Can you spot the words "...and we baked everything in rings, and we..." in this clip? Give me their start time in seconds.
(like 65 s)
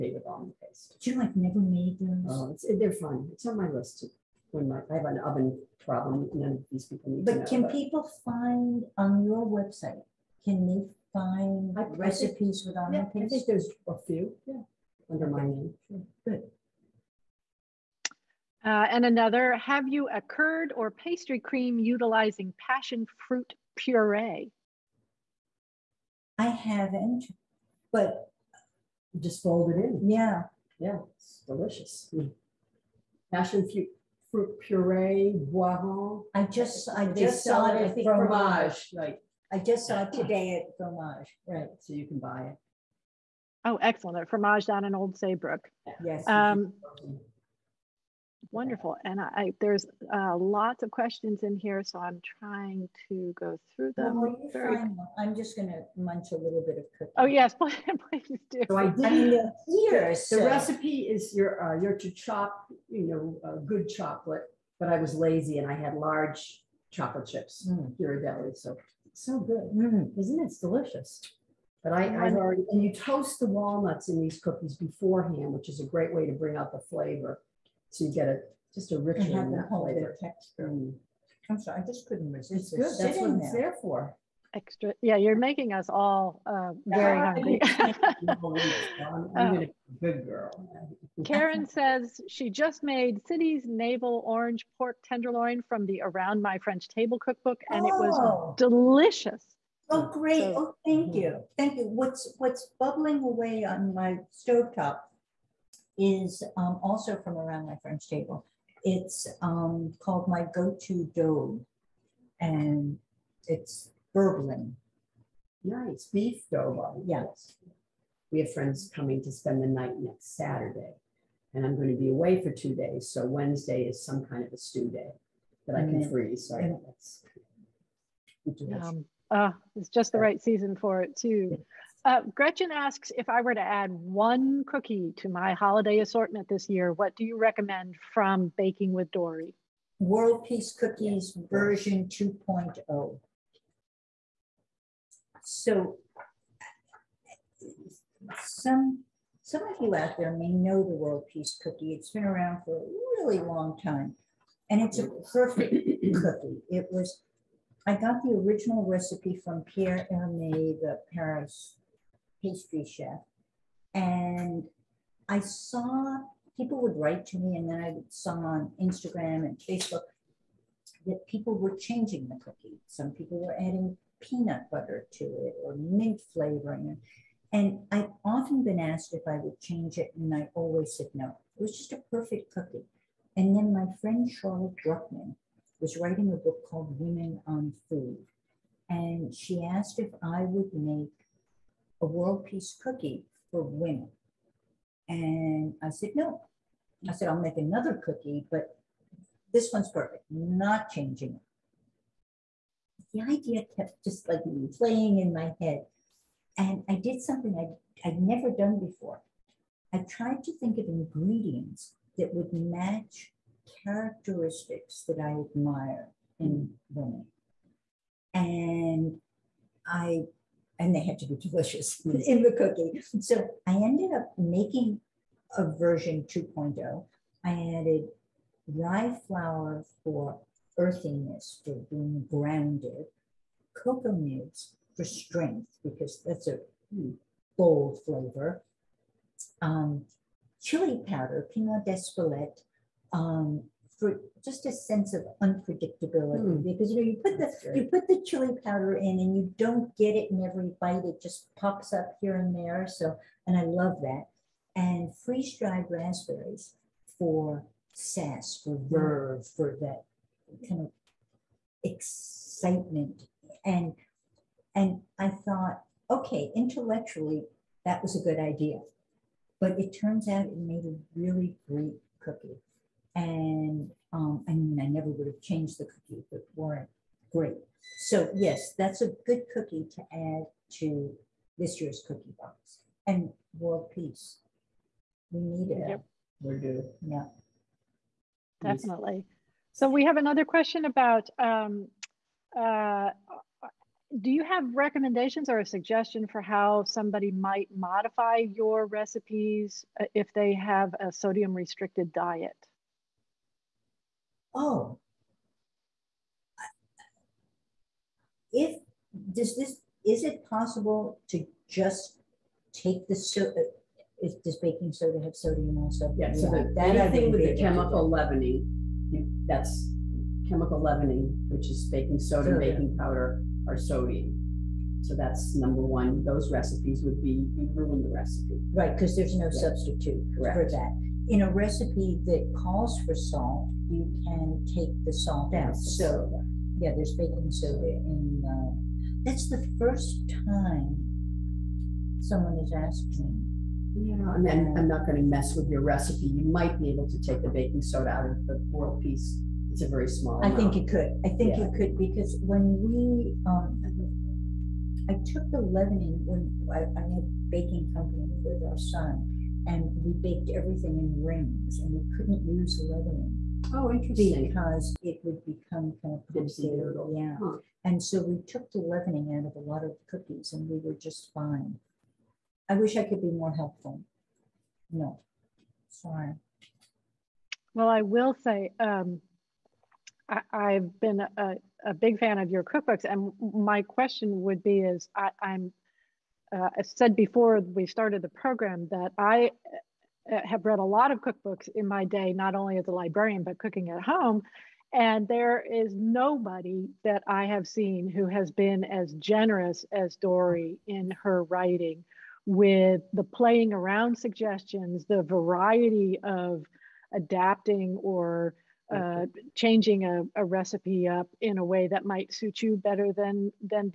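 359 s.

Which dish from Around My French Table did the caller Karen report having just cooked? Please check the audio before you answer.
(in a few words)
Navel orange pork tenderloin.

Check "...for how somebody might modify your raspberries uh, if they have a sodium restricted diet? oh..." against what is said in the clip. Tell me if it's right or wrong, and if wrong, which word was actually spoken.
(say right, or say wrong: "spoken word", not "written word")
wrong: "recipes", not "raspberries".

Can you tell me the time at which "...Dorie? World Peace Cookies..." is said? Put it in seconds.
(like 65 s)
139 s.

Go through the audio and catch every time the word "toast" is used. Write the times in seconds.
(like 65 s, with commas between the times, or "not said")
72 s.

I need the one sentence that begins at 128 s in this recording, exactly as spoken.
Um, uh, it's just the right season for it too.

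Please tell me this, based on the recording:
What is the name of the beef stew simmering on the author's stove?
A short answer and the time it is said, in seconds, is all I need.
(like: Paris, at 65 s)
My Go-To daube, at 110 s.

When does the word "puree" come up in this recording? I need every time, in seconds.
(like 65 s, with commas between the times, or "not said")
23 s, 34 s.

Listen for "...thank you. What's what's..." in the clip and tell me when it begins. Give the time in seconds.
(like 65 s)
101 s.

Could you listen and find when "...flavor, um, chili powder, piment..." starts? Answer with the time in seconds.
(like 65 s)
238 s.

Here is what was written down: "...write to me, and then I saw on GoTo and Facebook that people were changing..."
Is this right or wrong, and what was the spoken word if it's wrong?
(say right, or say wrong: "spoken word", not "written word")
wrong: "Instagram", not "GoTo".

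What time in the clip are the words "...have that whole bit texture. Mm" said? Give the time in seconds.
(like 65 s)
79 s.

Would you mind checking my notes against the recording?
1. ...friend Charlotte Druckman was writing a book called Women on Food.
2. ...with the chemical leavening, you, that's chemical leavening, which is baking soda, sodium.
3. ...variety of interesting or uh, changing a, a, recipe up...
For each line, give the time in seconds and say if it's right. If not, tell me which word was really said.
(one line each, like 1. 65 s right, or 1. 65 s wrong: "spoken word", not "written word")
1. 184 s right
2. 317 s right
3. 405 s wrong: "adapting", not "interesting".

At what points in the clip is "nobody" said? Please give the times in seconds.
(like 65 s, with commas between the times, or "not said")
395 s.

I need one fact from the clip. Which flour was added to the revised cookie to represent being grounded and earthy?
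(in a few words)
Rye flour.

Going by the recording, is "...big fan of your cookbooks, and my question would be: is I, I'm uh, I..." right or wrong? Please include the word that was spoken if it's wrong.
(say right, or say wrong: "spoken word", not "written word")
right.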